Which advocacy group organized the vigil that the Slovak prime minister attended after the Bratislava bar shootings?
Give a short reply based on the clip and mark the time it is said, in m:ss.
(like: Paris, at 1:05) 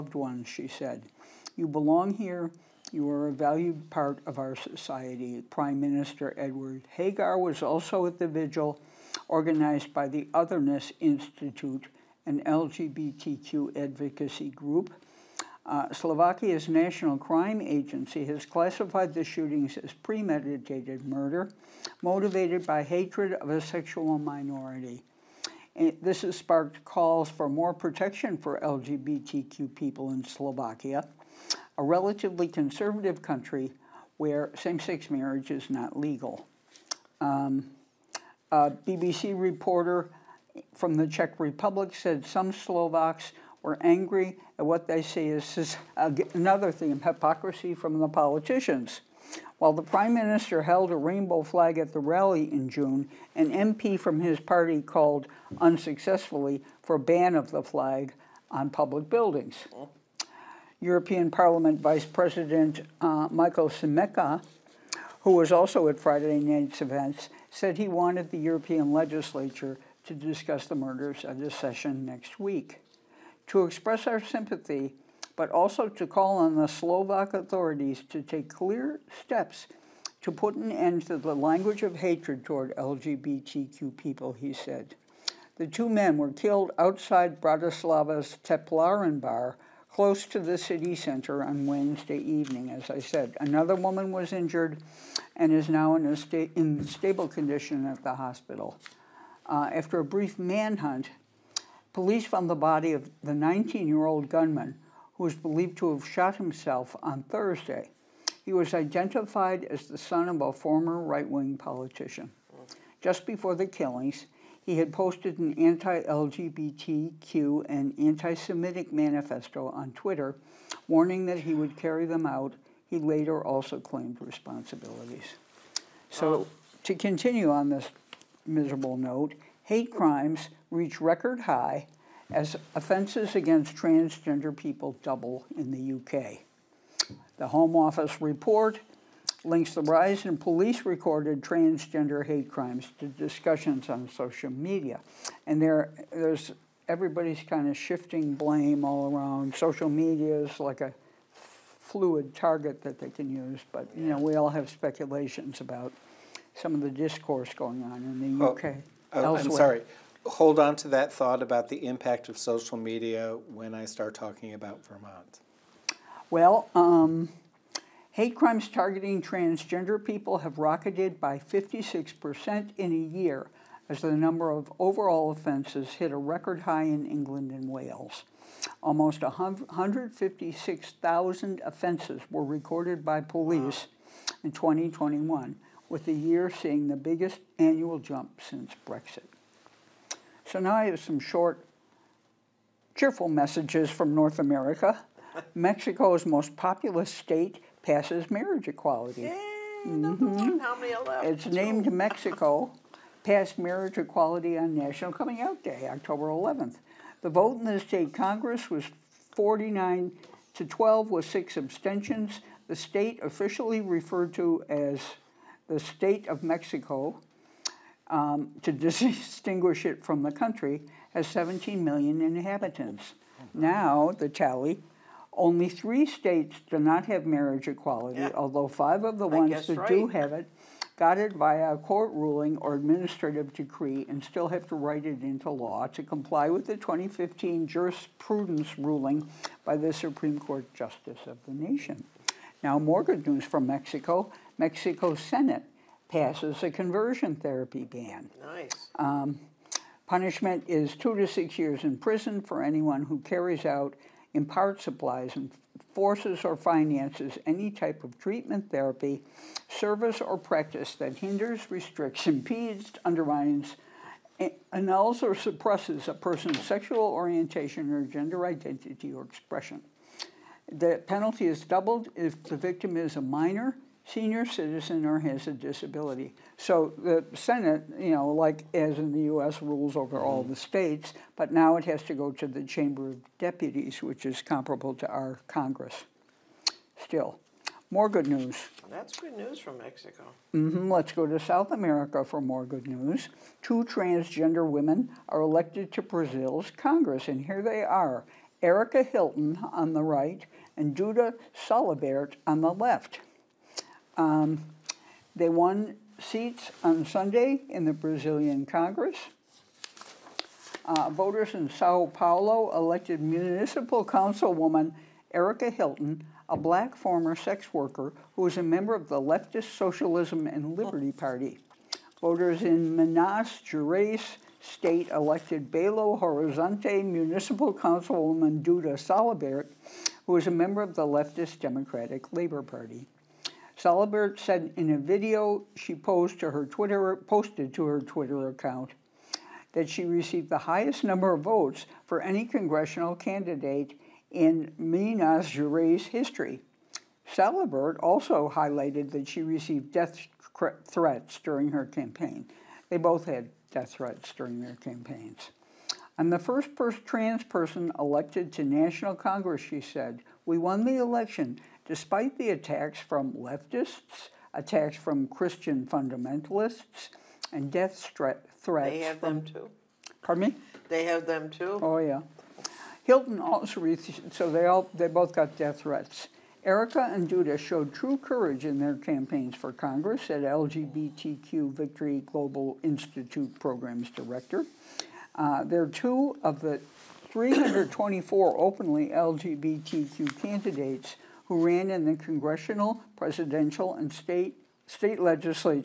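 Otherness Institute, at 0:10.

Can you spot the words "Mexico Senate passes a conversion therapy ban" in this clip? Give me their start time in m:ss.
4:04.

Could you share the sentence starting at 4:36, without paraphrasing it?
So the Senate, you know, like as in the U.S., rules over all mm-hmm.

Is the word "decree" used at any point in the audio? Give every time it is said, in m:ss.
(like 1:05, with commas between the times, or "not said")
3:53.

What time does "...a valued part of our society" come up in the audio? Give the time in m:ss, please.
0:03.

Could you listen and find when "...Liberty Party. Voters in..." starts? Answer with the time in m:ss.
5:20.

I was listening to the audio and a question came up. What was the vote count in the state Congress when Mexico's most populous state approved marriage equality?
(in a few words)
49 to 12.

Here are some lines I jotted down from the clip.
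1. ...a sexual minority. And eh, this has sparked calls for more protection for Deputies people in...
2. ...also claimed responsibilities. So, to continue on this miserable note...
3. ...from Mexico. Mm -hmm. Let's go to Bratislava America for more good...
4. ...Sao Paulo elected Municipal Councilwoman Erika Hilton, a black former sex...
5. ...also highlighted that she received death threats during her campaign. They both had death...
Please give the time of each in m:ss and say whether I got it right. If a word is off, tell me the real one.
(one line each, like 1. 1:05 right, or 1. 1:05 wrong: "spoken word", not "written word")
1. 0:23 wrong: "LGBTQ", not "Deputies"
2. 2:03 right
3. 4:49 wrong: "South", not "Bratislava"
4. 5:11 right
5. 5:47 right.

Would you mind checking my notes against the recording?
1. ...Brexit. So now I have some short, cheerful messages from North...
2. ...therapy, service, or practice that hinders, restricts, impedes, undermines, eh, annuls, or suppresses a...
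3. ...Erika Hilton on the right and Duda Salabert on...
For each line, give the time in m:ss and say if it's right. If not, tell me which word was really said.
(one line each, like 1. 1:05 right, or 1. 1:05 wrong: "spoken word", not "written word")
1. 3:08 right
2. 4:18 right
3. 4:58 right.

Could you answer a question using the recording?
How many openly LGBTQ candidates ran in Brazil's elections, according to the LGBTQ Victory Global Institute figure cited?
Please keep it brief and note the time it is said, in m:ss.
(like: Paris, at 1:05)
324, at 6:27.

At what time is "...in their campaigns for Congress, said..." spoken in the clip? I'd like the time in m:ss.
6:18.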